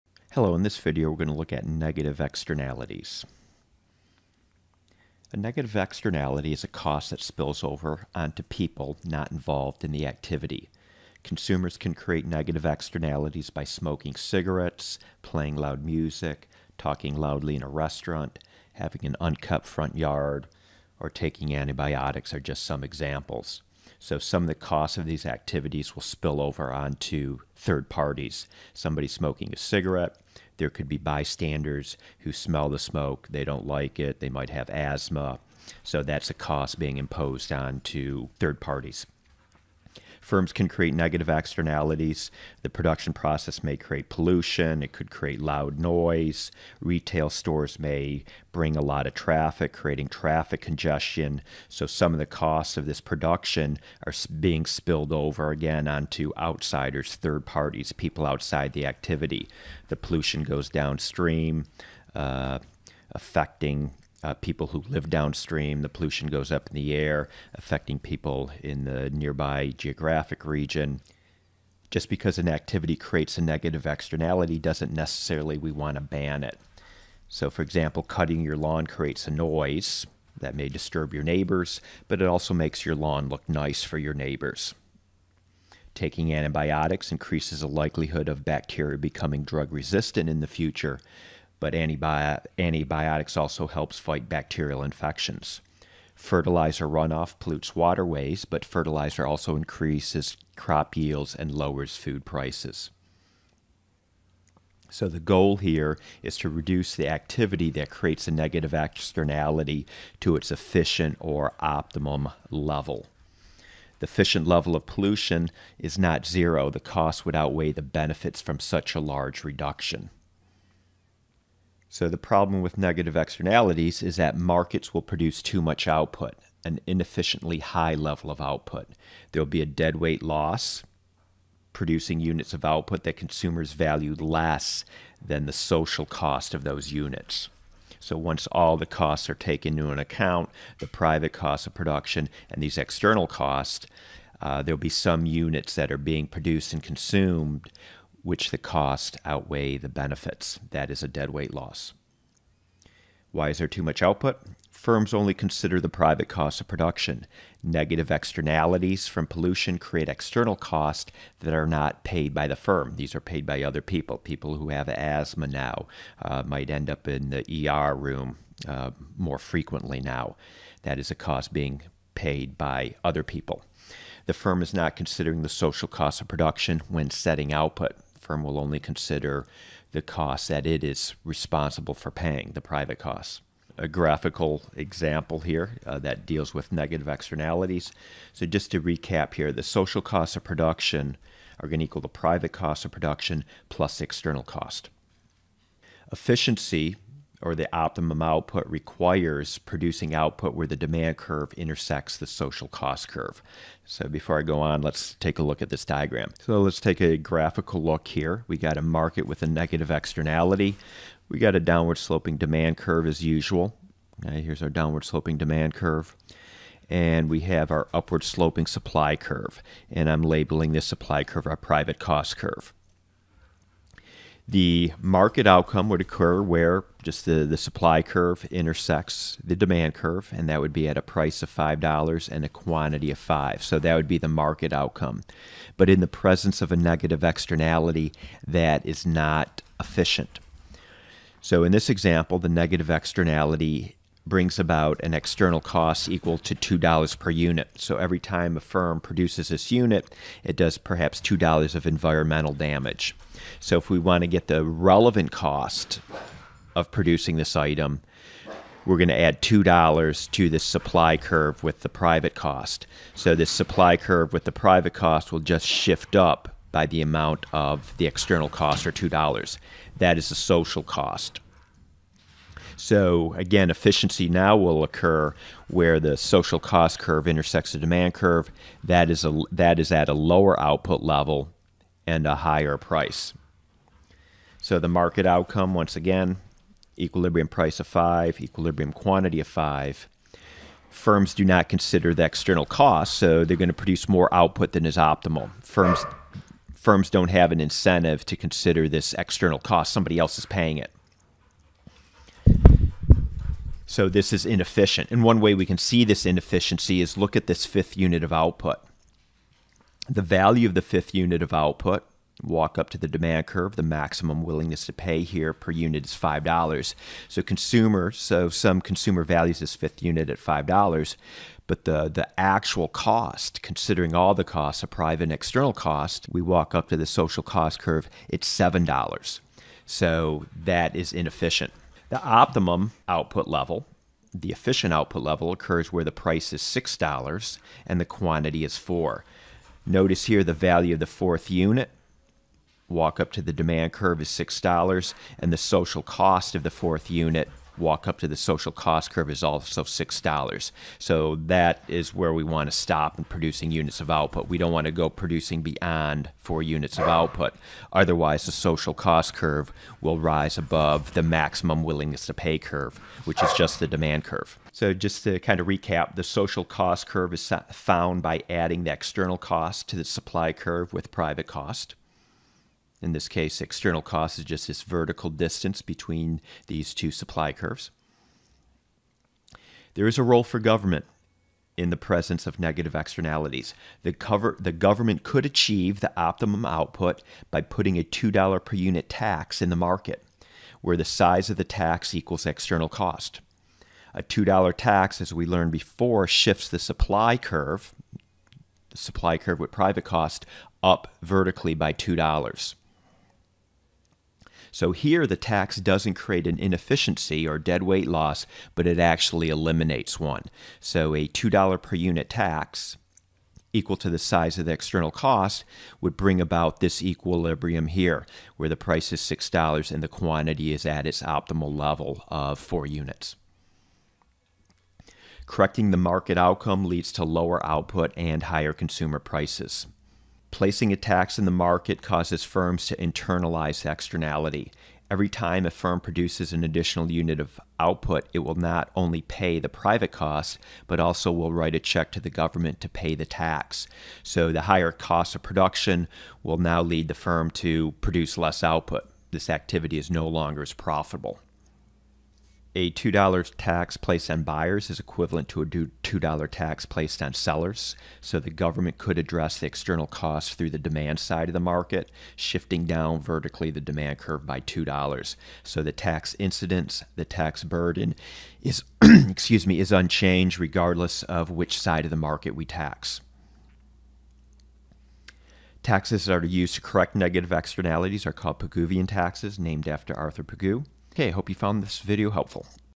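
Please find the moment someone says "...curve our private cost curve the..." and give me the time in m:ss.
3:41.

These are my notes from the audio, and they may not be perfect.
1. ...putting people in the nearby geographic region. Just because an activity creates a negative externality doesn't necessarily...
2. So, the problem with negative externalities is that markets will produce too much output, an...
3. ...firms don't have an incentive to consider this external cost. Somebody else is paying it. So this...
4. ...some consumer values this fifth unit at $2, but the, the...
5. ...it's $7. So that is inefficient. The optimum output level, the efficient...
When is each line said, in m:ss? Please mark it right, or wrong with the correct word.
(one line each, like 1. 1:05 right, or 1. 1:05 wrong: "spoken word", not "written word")
1. 1:07 wrong: "affecting", not "putting"
2. 2:01 right
3. 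4:56 right
4. 5:18 wrong: "5", not "2"
5. 5:28 right.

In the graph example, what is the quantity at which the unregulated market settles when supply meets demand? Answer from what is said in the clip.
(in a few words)
5.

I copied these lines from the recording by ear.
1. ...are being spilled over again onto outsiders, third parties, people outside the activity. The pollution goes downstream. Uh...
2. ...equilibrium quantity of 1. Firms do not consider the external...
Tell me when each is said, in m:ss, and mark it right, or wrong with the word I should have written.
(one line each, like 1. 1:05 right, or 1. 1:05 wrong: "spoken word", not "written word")
1. 0:54 right
2. 4:48 wrong: "5", not "1".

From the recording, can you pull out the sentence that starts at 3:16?
Efficiency or the optimum output requires producing output where the demand curve intersects the social cost curve.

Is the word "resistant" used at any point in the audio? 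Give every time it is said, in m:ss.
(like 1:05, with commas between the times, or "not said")
1:29.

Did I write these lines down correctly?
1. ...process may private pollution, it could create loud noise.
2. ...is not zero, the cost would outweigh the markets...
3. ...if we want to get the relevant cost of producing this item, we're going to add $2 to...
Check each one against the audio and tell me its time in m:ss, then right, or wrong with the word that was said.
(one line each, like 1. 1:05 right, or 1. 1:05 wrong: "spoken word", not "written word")
1. 0:43 wrong: "create", not "private"
2. 1:55 wrong: "benefits", not "markets"
3. 4:13 right.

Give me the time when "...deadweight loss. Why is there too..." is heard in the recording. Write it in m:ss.
2:31.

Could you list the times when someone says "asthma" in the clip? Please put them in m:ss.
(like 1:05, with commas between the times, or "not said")
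0:34, 2:44.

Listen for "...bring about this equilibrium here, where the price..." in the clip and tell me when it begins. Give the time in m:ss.
6:56.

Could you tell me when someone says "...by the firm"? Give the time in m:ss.
2:42.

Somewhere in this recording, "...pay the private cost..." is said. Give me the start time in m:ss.
7:19.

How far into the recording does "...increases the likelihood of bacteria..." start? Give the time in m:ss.
1:27.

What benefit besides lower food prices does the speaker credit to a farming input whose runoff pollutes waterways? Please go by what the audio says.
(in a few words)
increases crop yields.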